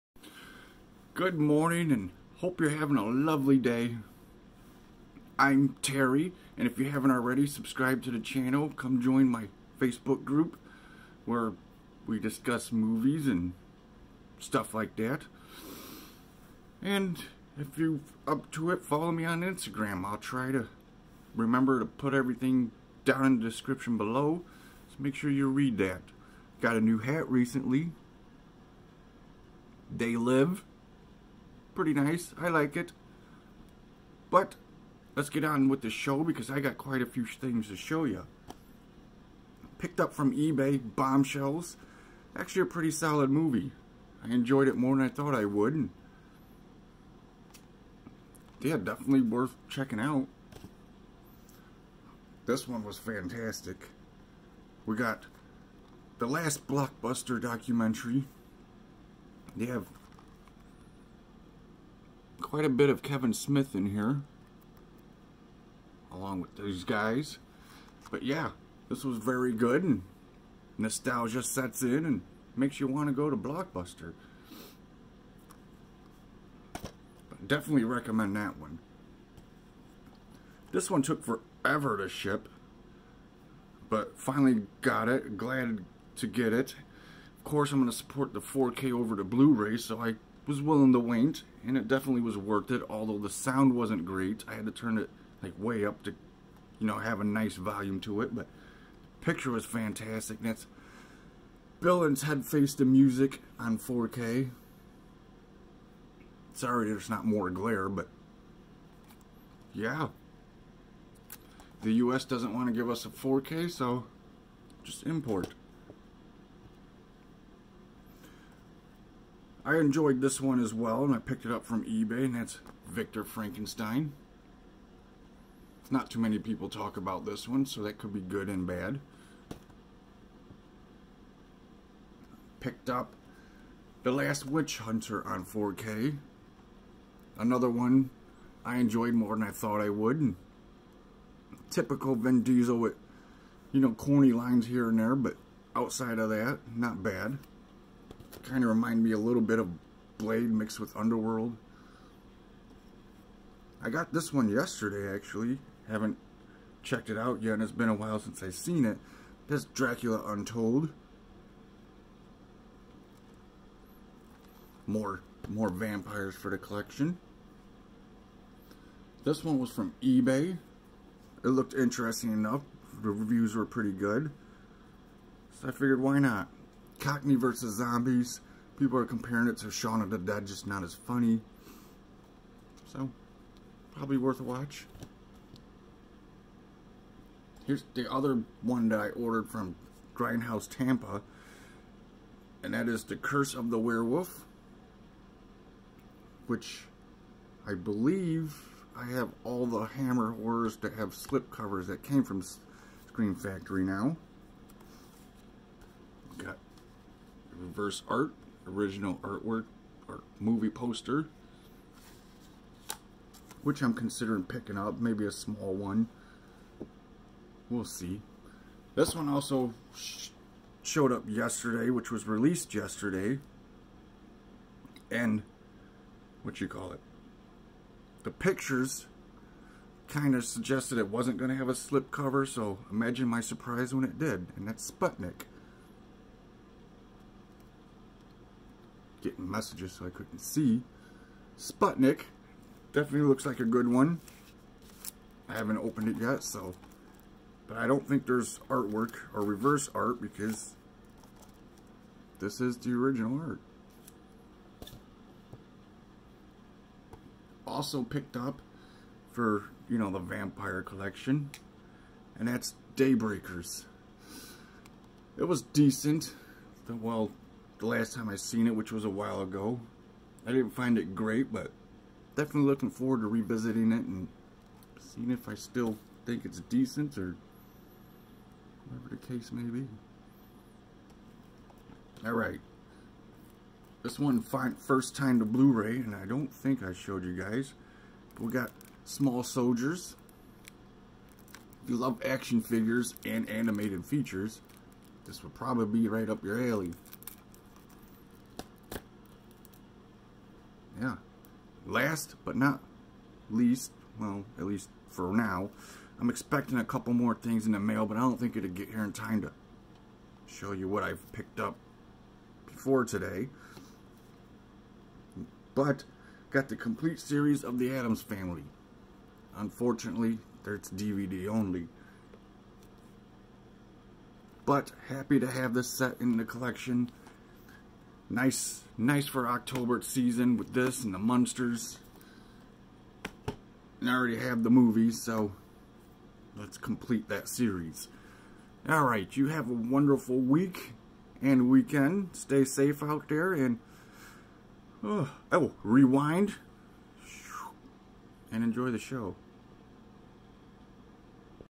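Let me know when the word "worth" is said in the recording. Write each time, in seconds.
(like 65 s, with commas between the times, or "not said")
49 s, 92 s, 184 s.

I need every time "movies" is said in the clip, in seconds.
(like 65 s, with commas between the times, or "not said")
12 s, 43 s, 210 s, 334 s.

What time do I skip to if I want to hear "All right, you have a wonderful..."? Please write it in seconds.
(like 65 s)
338 s.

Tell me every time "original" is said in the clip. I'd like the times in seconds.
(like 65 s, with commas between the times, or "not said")
208 s, 252 s.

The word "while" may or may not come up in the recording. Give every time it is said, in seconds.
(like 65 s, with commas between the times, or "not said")
157 s, 269 s.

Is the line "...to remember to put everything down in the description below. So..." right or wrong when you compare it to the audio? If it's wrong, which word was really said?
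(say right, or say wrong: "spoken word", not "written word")
right.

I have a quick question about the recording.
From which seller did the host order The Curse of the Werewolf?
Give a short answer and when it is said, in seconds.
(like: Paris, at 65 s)
Grindhouse Tampa, at 190 s.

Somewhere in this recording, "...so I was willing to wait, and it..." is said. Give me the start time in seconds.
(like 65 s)
89 s.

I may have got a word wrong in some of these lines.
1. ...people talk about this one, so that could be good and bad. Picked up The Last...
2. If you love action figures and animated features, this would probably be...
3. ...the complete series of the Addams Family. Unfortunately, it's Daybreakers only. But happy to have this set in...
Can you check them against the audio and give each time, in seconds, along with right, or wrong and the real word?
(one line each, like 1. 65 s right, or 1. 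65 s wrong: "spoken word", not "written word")
1. 126 s right
2. 291 s right
3. 316 s wrong: "DVD", not "Daybreakers".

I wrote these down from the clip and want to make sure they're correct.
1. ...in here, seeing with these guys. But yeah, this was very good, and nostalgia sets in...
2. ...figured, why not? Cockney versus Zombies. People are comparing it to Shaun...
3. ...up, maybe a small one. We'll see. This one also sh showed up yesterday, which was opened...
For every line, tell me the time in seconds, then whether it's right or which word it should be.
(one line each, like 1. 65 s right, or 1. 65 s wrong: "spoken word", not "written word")
1. 63 s wrong: "along", not "seeing"
2. 175 s right
3. 214 s wrong: "released", not "opened".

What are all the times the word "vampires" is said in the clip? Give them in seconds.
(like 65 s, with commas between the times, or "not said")
165 s, 260 s.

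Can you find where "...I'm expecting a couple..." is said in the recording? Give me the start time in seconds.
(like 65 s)
306 s.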